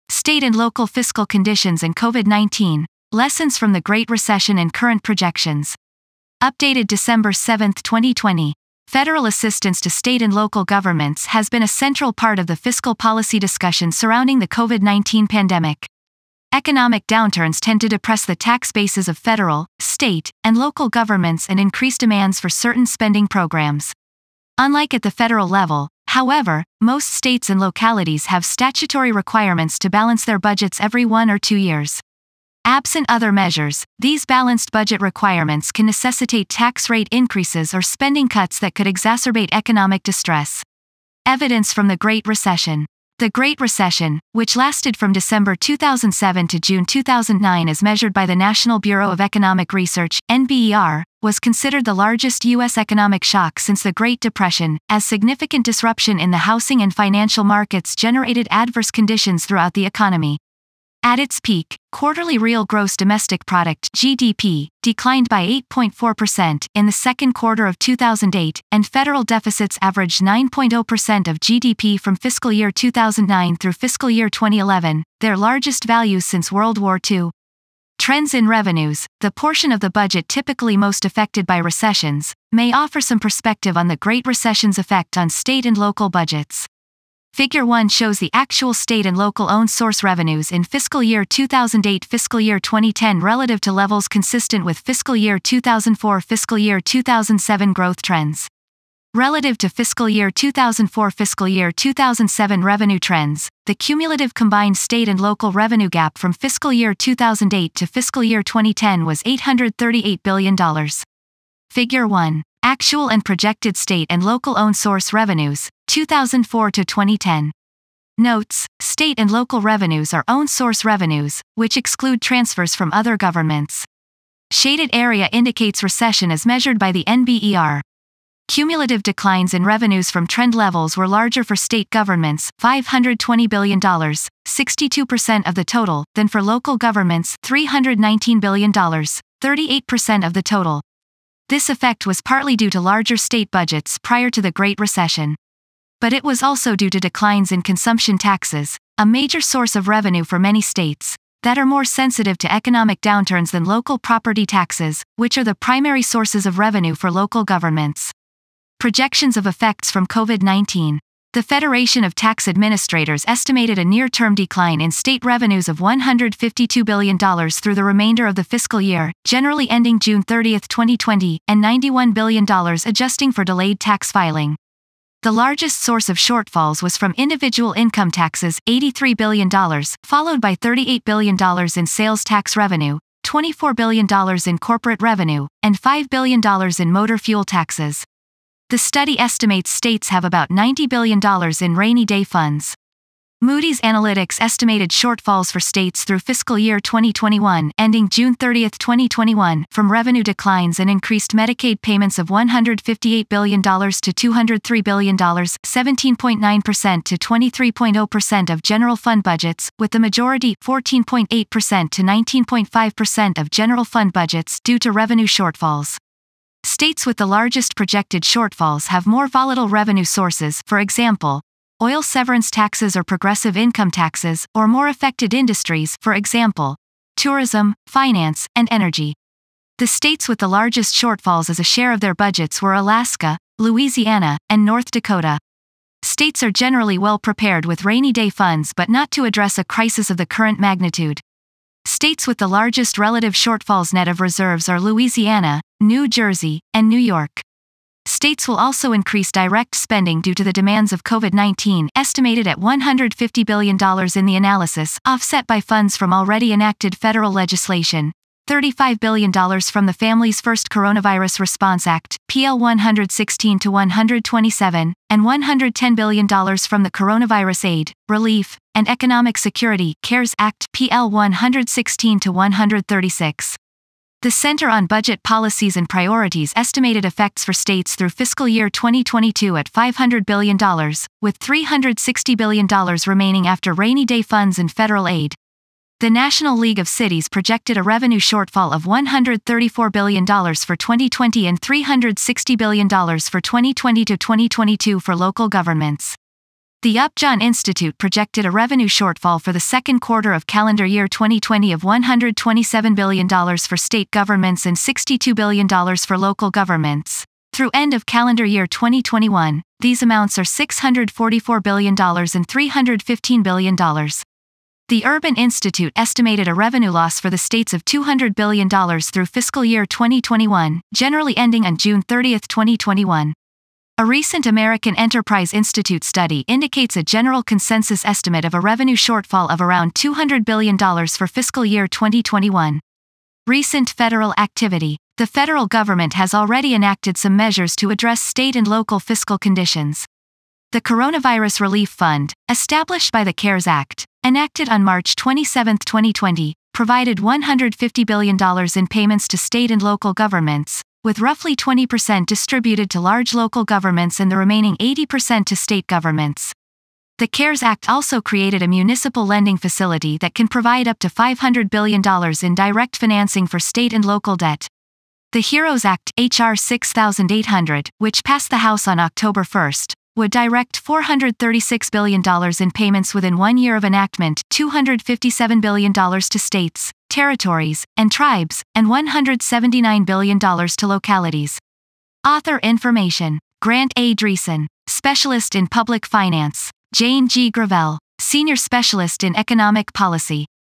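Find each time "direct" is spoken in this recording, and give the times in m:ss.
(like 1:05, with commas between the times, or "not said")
4:09, 6:02, 6:10.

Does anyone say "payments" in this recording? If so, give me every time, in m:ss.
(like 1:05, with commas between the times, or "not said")
3:21, 5:48, 6:12.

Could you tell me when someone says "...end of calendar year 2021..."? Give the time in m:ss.
5:07.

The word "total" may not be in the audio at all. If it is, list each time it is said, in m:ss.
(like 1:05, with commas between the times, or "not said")
2:15, 2:20.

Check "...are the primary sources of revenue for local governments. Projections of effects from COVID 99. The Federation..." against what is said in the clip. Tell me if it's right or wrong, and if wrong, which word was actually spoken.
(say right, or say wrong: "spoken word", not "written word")
wrong: "19", not "99".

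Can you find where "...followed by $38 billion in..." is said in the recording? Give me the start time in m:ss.
3:00.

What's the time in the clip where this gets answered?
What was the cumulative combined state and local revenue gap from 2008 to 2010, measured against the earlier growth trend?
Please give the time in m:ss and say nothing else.
1:49.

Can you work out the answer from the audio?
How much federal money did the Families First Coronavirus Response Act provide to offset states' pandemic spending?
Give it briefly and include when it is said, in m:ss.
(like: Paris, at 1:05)
$35 billion, at 4:18.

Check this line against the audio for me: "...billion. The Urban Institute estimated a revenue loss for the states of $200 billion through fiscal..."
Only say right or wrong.
right.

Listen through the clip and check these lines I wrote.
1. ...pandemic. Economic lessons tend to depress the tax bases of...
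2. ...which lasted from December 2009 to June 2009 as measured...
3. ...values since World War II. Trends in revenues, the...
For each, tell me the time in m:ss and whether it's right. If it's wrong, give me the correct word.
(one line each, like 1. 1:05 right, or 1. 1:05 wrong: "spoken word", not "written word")
1. 0:15 wrong: "downturns", not "lessons"
2. 0:44 wrong: "2007", not "2009"
3. 1:15 right.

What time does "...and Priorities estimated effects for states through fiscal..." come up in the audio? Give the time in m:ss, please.
4:35.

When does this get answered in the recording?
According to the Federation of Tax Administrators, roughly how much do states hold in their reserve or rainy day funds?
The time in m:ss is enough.
3:10.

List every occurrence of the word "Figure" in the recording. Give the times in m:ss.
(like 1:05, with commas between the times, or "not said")
1:27, 1:51.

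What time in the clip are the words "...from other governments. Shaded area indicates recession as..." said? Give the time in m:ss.
2:02.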